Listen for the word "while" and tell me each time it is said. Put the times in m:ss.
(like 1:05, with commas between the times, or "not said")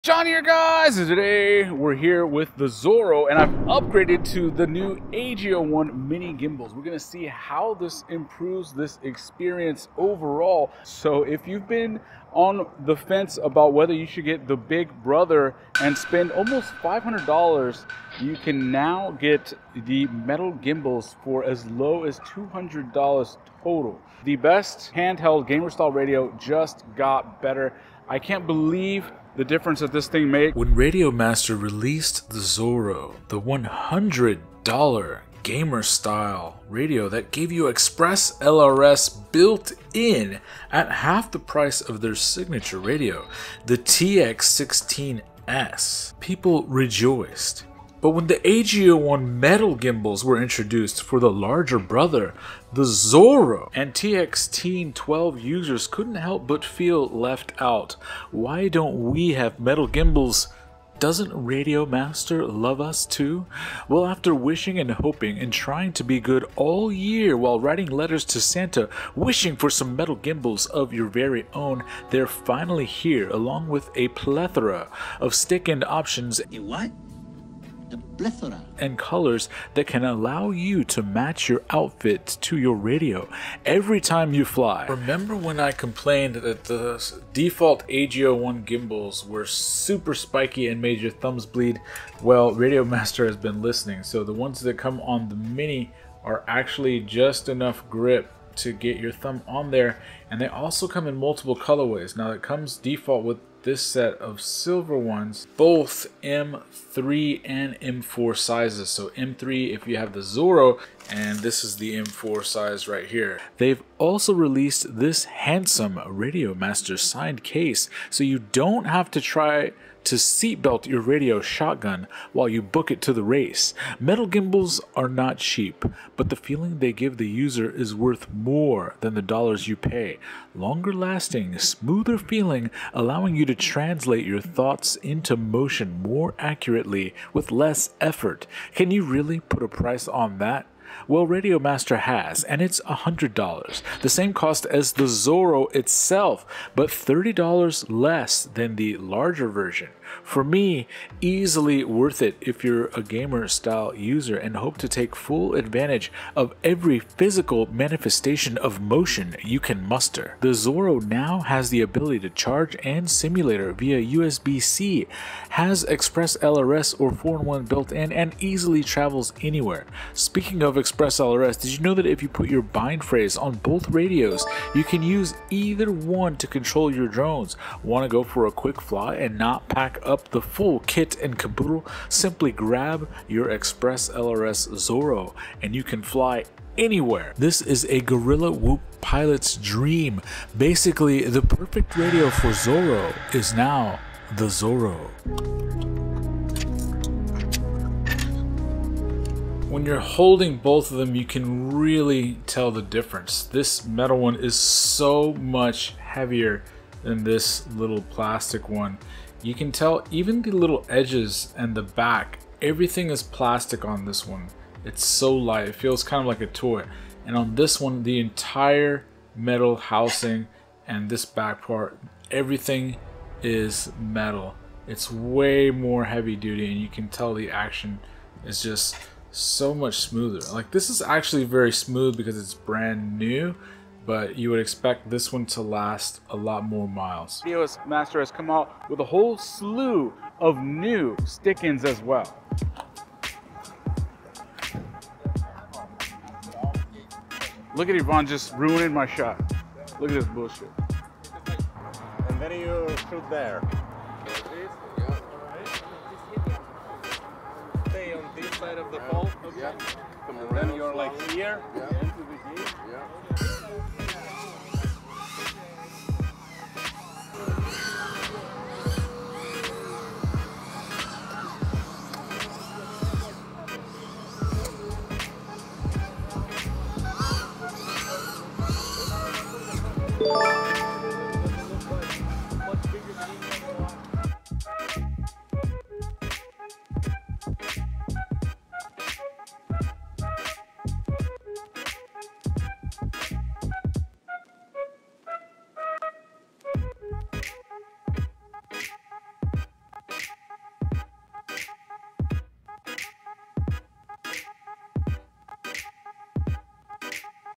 1:07, 2:02.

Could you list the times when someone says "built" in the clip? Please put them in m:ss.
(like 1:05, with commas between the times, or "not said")
0:39, 2:47.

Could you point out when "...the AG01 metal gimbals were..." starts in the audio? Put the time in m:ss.
0:48.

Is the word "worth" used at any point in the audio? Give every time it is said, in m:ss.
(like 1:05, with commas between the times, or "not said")
2:07, 2:31.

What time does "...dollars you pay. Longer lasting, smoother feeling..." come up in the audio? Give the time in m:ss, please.
2:09.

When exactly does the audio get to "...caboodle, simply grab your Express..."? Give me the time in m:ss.
3:01.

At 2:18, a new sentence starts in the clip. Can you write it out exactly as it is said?
Can you really put a price on that?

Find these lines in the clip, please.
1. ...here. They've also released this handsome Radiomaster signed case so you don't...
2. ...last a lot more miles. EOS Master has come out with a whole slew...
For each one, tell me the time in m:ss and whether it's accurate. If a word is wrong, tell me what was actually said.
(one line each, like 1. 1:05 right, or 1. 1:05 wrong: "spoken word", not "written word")
1. 1:53 right
2. 3:55 right.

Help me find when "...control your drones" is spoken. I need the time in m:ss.
2:56.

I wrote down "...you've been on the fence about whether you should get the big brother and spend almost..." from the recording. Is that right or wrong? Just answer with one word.
right.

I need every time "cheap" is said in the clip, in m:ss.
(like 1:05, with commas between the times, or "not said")
2:05.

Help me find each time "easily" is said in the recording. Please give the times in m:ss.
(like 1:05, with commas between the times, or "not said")
2:31, 2:48.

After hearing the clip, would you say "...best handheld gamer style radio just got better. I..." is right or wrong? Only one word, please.
right.